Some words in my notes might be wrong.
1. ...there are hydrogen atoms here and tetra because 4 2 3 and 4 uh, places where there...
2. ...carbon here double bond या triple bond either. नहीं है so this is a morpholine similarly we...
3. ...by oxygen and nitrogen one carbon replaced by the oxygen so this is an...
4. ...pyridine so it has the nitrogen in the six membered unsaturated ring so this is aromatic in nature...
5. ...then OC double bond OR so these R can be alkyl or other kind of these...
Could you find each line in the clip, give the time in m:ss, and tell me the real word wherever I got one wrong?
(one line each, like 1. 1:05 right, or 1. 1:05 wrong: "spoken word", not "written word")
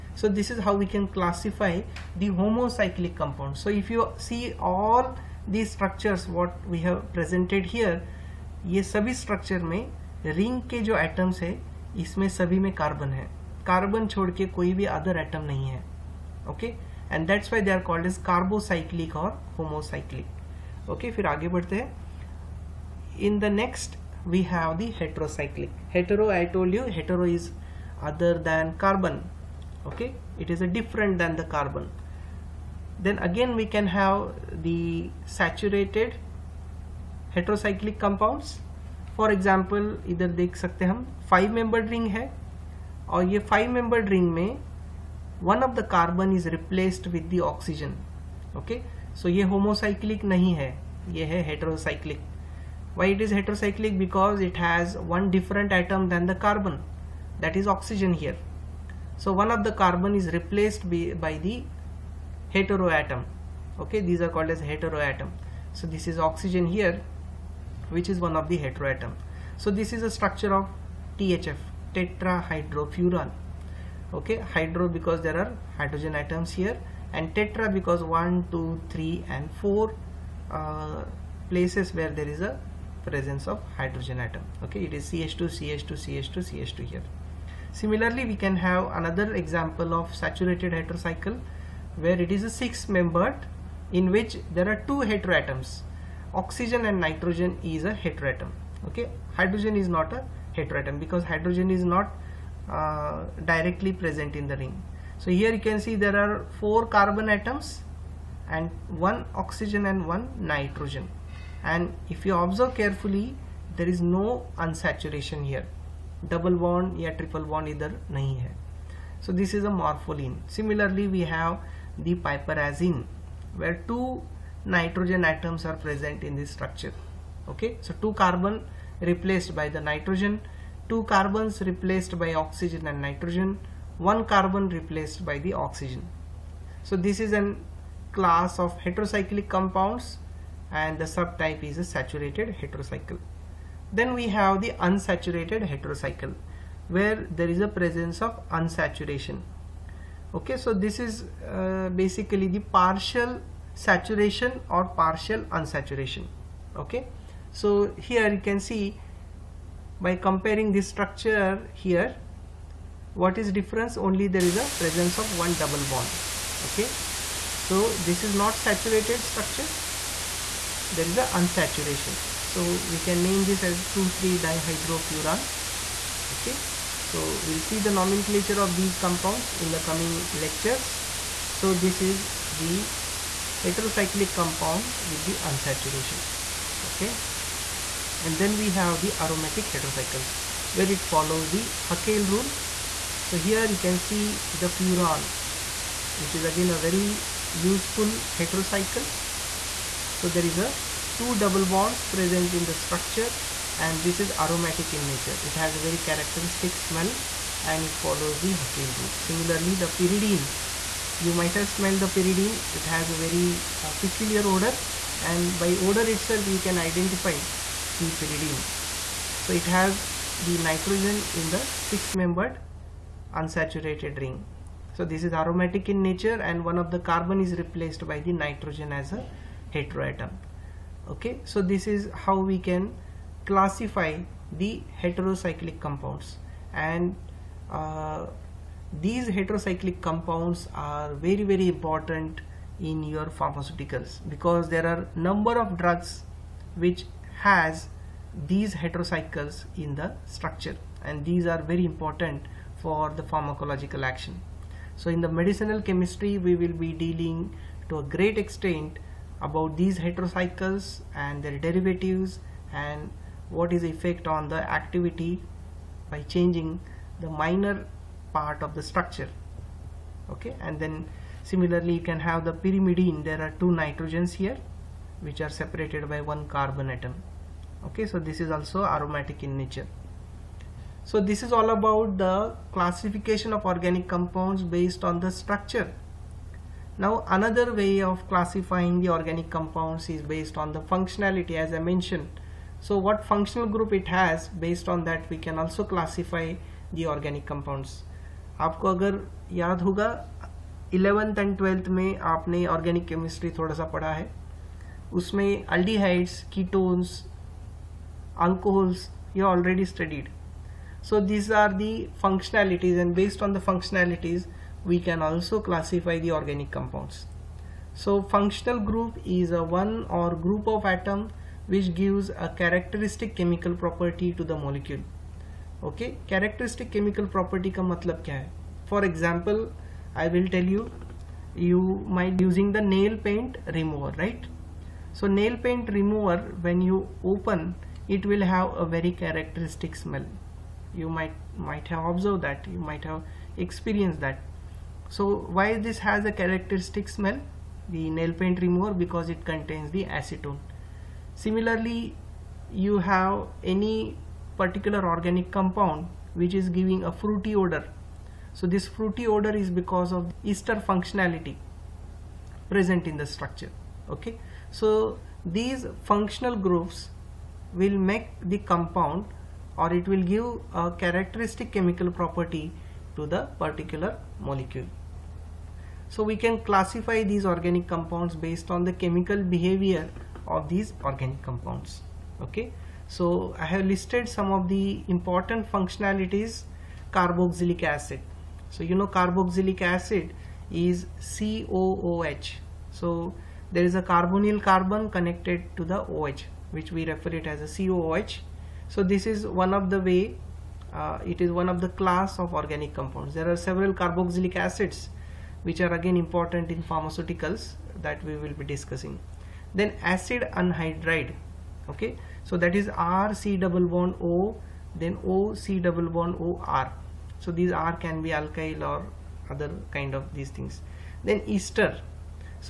1. 1:15 wrong: "1", not "4"
2. 1:54 wrong: "unsaturation", not "carbon"
3. 2:12 right
4. 3:38 right
5. 6:55 right.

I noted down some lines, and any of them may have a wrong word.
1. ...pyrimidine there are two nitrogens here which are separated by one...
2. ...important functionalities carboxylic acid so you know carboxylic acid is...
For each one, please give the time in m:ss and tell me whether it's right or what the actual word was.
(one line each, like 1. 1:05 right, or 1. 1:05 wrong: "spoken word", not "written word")
1. 4:32 right
2. 6:25 right.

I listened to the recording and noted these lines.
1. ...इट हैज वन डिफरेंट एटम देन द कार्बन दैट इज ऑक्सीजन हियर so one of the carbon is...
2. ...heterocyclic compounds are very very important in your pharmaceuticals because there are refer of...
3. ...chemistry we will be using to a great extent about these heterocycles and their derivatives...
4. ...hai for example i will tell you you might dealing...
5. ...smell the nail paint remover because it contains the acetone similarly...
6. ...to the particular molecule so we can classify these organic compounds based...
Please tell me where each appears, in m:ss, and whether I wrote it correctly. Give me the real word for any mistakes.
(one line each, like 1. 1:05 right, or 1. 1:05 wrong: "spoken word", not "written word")
1. 0:54 right
2. 3:59 wrong: "number", not "refer"
3. 4:15 wrong: "dealing", not "using"
4. 5:28 wrong: "using", not "dealing"
5. 5:47 right
6. 6:13 right.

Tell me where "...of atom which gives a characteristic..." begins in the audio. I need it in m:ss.
5:20.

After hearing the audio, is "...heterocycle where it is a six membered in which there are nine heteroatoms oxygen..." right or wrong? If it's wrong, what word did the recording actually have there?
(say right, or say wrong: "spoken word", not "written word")
wrong: "two", not "nine".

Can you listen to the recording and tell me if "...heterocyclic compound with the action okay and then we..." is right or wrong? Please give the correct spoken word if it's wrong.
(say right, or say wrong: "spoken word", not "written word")
wrong: "unsaturation", not "action".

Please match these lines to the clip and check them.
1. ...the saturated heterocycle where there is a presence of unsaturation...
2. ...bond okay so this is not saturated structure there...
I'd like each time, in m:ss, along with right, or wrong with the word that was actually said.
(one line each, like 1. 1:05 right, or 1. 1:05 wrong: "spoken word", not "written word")
1. 2:24 wrong: "unsaturated", not "saturated"
2. 2:45 right.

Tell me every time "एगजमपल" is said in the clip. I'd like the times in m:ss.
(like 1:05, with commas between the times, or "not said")
0:39.